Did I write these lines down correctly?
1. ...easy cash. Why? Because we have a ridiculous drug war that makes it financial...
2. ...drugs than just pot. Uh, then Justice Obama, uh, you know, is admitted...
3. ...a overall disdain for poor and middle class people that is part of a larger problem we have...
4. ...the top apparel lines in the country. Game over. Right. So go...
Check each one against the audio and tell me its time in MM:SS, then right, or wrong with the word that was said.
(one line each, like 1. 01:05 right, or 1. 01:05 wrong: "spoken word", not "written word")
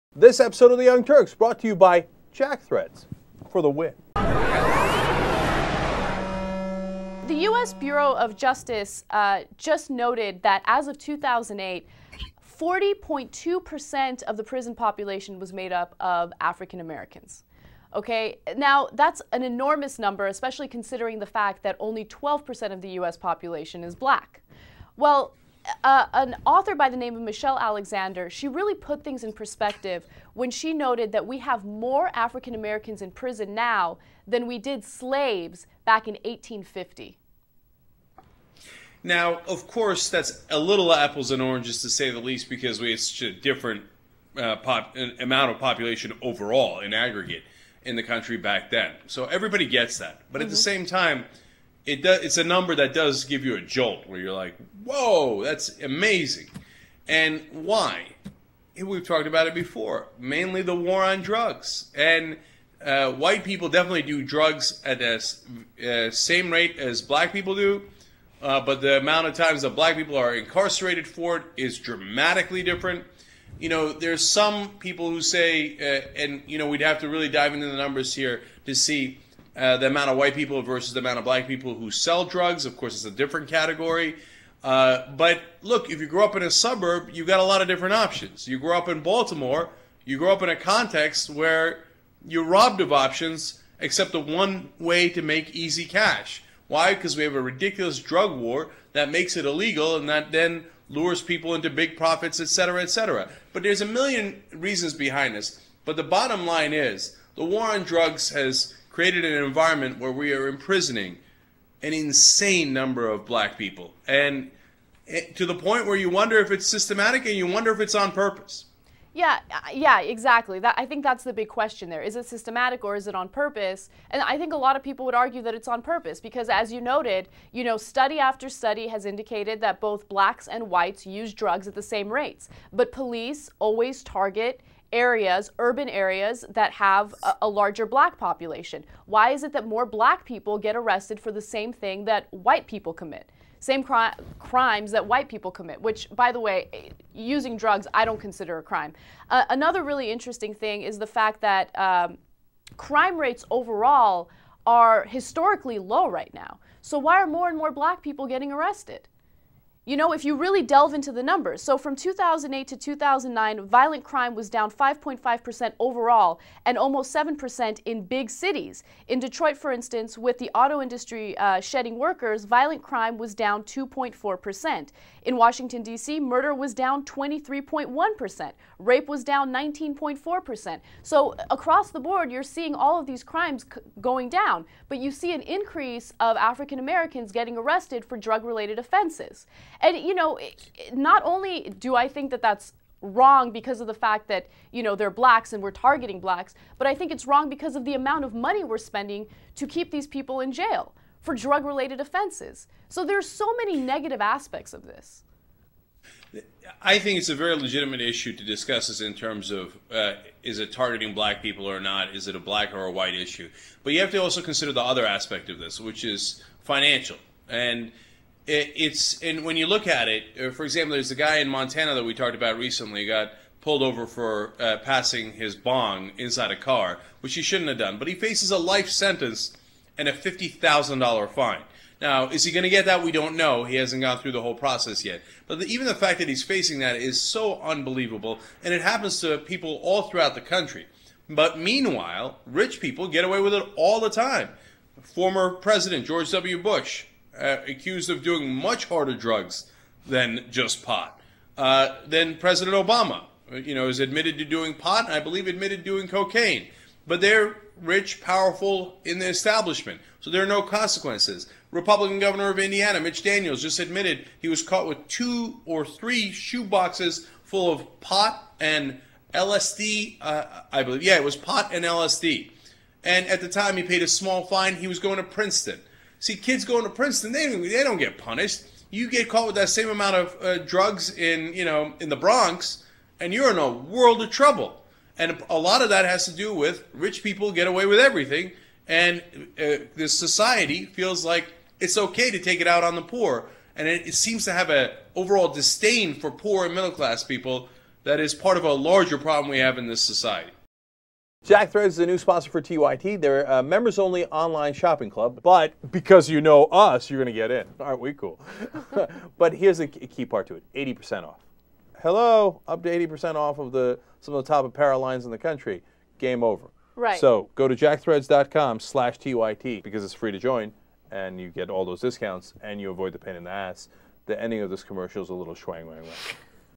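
1. 01:35 wrong: "illegal", not "financial"
2. 04:09 wrong: "President", not "Justice"
3. 04:54 right
4. 05:14 right.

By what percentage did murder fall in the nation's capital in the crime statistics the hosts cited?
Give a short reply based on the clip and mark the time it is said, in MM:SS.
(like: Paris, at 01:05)
23.1%, at 02:57.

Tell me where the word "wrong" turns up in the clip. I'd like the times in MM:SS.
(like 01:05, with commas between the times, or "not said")
03:13, 03:17.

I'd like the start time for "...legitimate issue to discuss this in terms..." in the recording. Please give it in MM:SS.
03:27.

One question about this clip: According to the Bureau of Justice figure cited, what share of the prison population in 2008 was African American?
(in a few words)
40.2%.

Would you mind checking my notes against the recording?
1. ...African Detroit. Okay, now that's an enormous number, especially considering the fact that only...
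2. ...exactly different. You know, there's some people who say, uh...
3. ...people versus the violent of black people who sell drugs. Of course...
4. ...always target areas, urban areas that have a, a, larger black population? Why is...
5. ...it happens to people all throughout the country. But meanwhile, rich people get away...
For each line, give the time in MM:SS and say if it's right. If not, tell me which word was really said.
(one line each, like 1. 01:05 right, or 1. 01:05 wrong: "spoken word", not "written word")
1. 00:16 wrong: "Americans", not "Detroit"
2. 01:11 wrong: "dramatically", not "exactly"
3. 01:20 wrong: "amount", not "violent"
4. 02:13 right
5. 03:58 right.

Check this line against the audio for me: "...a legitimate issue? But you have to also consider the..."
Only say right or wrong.
wrong.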